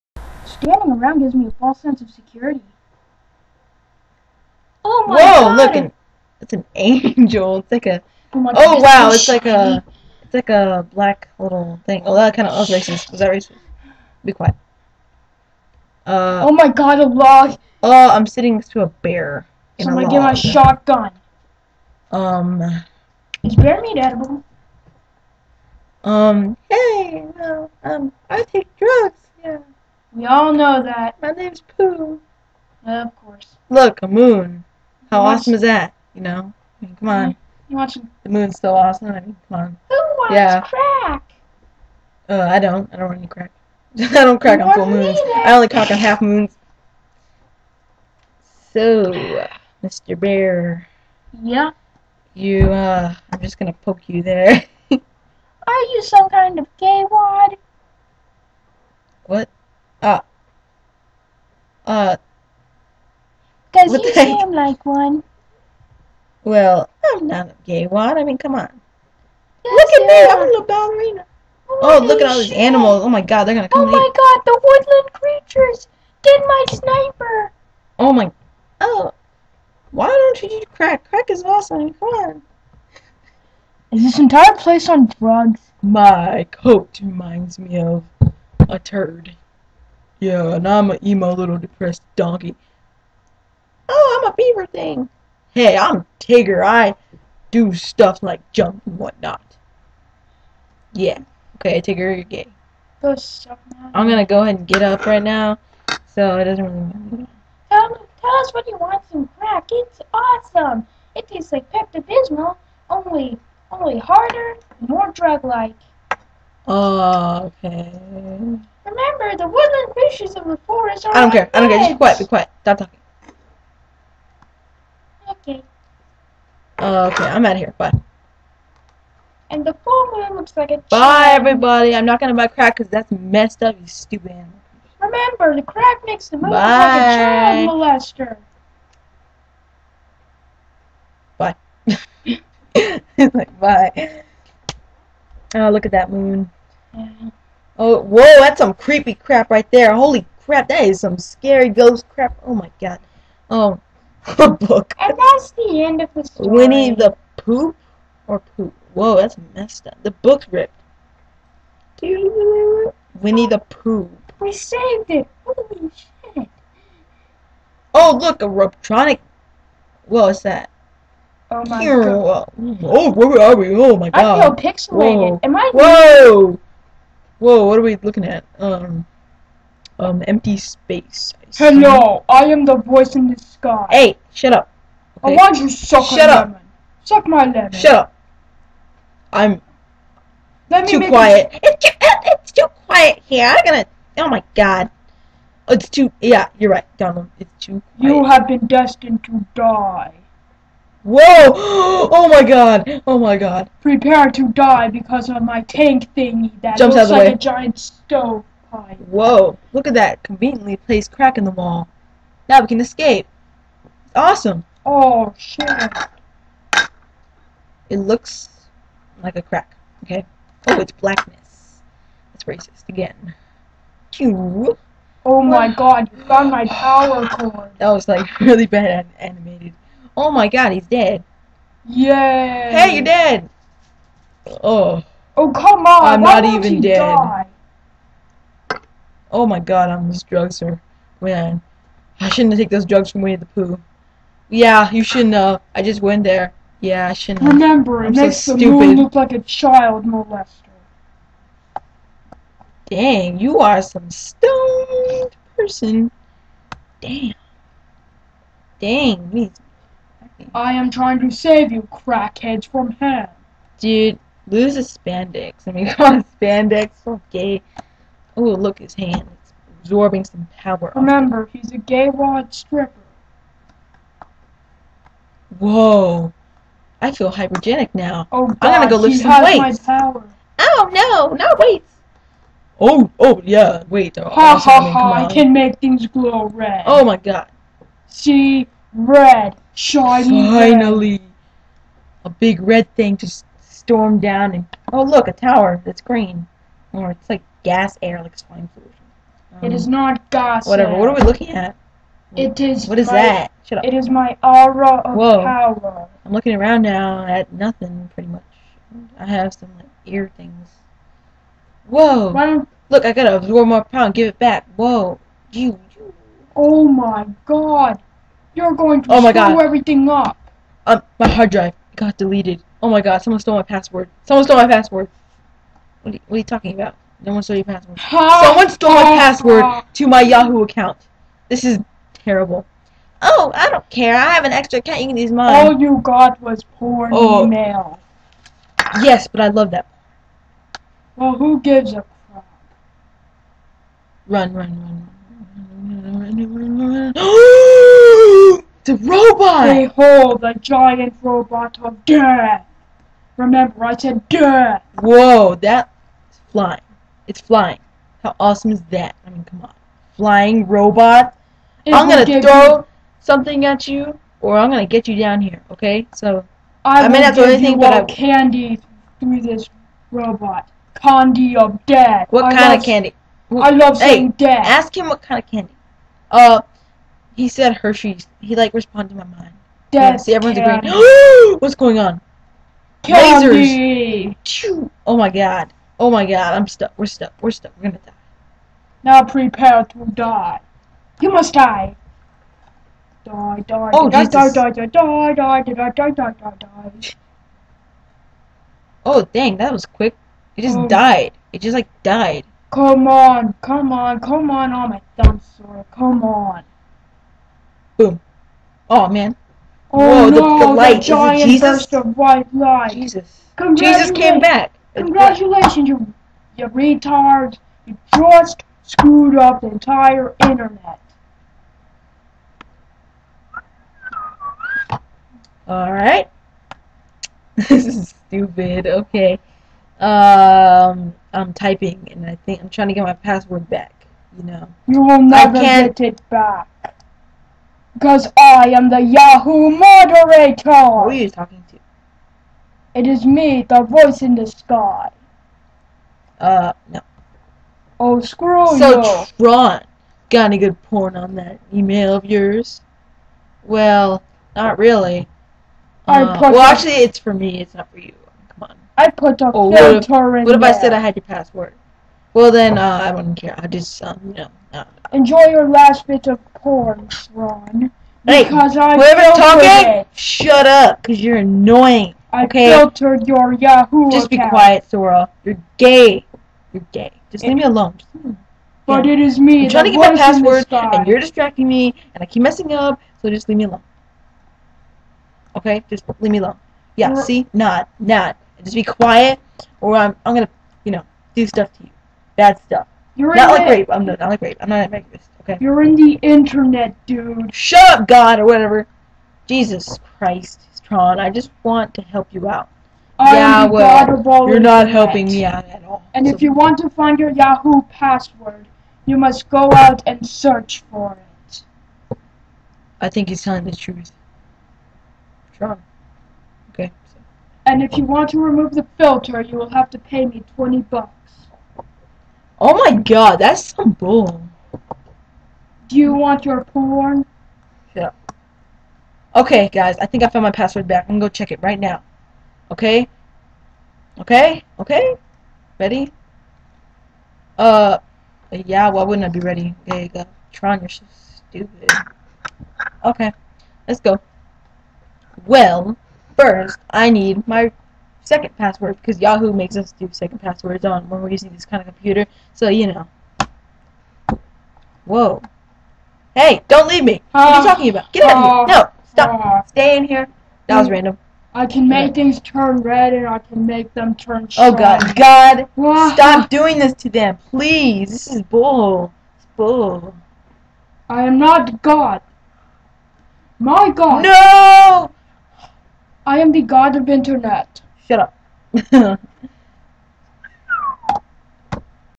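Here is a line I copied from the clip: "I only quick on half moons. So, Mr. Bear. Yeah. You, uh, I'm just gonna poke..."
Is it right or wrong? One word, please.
wrong.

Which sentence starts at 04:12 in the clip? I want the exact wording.
Dang, you are some stoned person.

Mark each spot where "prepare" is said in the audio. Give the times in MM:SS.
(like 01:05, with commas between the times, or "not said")
03:23, 06:29.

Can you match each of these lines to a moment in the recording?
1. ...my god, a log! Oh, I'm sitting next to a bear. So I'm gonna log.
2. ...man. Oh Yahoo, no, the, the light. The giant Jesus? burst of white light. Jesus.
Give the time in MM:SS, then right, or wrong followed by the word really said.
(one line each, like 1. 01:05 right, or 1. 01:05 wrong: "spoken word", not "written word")
1. 00:16 right
2. 06:49 wrong: "Whoa", not "Yahoo".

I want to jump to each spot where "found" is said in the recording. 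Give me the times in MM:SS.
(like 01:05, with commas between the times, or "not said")
03:46, 08:50.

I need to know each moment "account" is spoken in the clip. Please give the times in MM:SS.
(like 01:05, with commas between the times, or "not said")
05:30, 05:34, 07:54.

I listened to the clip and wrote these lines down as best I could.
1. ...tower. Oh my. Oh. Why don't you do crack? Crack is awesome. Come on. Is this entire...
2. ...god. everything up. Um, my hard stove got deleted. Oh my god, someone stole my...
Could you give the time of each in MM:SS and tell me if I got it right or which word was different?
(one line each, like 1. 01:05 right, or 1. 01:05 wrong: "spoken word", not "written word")
1. 01:16 wrong: "sniper", not "tower"
2. 05:19 wrong: "drive", not "stove".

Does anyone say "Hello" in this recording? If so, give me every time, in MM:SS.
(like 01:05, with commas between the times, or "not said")
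03:01.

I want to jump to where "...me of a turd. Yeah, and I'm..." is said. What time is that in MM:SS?
01:27.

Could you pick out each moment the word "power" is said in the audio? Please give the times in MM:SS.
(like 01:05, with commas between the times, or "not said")
03:46, 04:30, 05:05, 05:13.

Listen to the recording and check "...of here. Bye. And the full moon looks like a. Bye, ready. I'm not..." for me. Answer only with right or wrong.
wrong.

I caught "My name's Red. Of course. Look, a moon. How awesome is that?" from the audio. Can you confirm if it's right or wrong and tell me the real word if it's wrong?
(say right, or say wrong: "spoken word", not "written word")
wrong: "Pooh", not "Red".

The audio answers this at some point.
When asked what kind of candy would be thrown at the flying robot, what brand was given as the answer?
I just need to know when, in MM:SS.
06:17.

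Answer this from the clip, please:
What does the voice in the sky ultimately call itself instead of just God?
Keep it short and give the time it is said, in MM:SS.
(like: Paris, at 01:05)
God of Internet, at 09:36.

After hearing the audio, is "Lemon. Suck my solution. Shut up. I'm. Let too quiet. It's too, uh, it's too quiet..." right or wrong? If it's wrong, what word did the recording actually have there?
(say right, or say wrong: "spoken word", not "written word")
wrong: "lemon", not "solution".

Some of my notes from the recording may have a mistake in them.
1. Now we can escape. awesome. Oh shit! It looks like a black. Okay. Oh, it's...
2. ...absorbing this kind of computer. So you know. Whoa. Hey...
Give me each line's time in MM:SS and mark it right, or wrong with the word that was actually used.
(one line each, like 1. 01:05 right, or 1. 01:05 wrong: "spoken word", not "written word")
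1. 03:32 wrong: "crack", not "black"
2. 09:11 wrong: "using", not "absorbing".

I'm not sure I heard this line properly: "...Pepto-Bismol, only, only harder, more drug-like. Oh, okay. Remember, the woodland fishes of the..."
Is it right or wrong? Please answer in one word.
right.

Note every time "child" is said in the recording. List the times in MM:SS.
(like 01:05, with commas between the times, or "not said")
02:17, 04:09.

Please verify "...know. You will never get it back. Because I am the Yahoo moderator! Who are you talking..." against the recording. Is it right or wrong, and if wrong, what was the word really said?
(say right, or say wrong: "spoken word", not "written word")
right.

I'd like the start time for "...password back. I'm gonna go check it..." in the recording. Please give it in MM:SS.
08:50.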